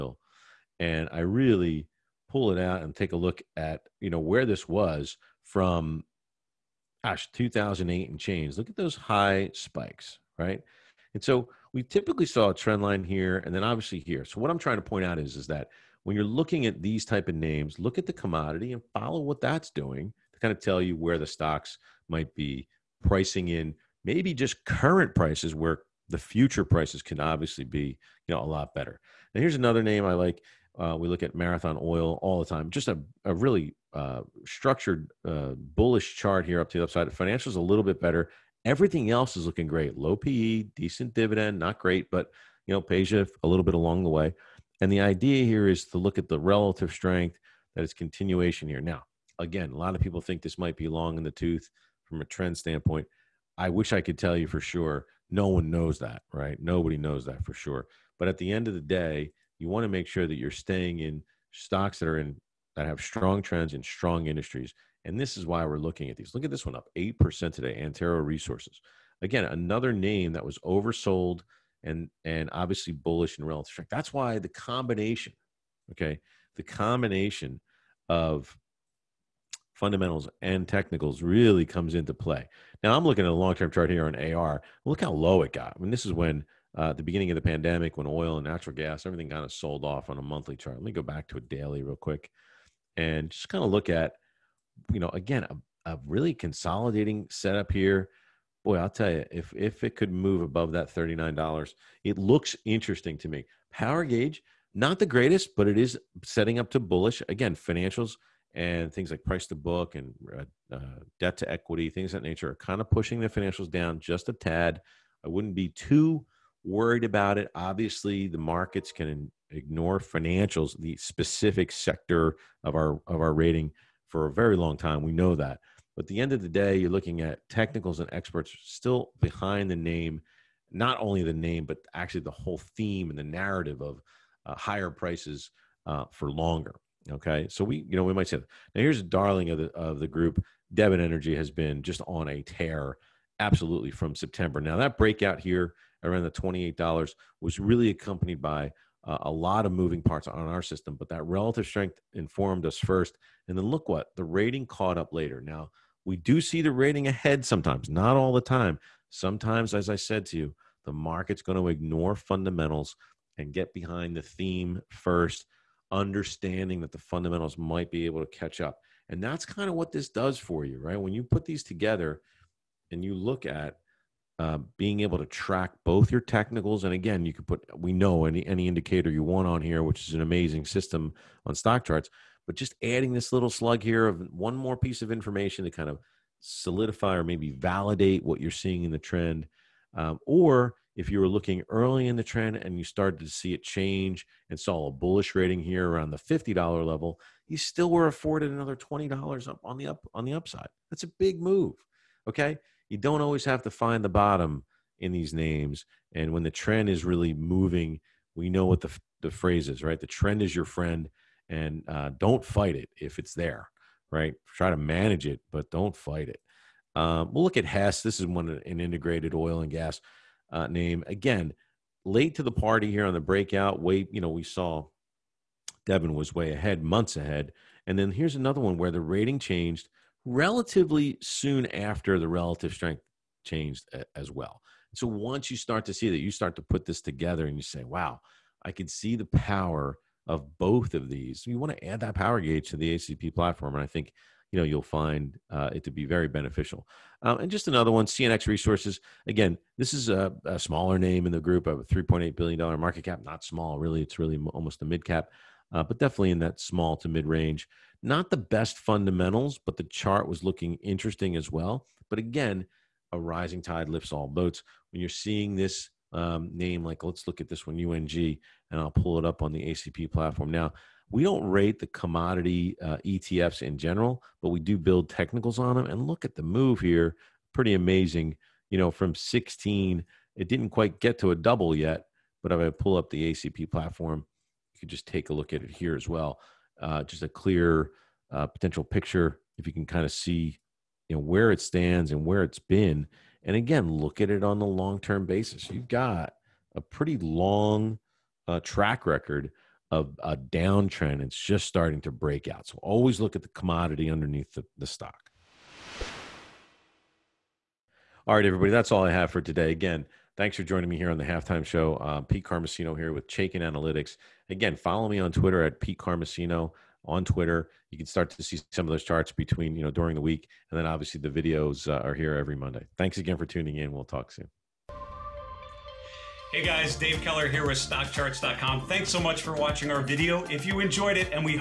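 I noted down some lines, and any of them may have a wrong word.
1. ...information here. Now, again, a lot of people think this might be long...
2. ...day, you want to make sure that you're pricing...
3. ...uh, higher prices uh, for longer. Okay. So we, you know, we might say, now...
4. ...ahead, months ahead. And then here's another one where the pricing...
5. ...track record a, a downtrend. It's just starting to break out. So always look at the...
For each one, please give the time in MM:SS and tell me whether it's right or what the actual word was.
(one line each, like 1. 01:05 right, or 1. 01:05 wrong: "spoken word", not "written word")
1. 00:47 wrong: "continuation", not "information"
2. 00:58 wrong: "staying", not "pricing"
3. 02:14 right
4. 03:46 wrong: "rating", not "pricing"
5. 04:58 right.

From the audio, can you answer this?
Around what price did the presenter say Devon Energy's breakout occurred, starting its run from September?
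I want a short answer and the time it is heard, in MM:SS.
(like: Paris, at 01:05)
$28, at 02:26.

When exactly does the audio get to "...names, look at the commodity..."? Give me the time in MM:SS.
00:17.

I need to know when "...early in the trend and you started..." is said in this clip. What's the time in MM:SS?
03:11.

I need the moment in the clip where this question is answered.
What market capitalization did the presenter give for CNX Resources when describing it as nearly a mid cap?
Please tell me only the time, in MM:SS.
04:11.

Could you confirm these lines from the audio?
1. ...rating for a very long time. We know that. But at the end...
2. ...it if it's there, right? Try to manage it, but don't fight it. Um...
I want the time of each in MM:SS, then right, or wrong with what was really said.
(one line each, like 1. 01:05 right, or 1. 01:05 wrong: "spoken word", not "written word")
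1. 02:03 right
2. 03:32 right.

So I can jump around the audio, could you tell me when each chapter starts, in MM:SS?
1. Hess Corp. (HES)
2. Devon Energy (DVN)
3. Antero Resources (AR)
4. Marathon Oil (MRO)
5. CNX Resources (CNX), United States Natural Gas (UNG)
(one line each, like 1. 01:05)
1. 03:35
2. 02:17
3. 01:04
4. 00:28
5. 04:05.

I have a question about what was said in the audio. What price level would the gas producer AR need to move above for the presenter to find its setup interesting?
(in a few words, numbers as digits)
$39.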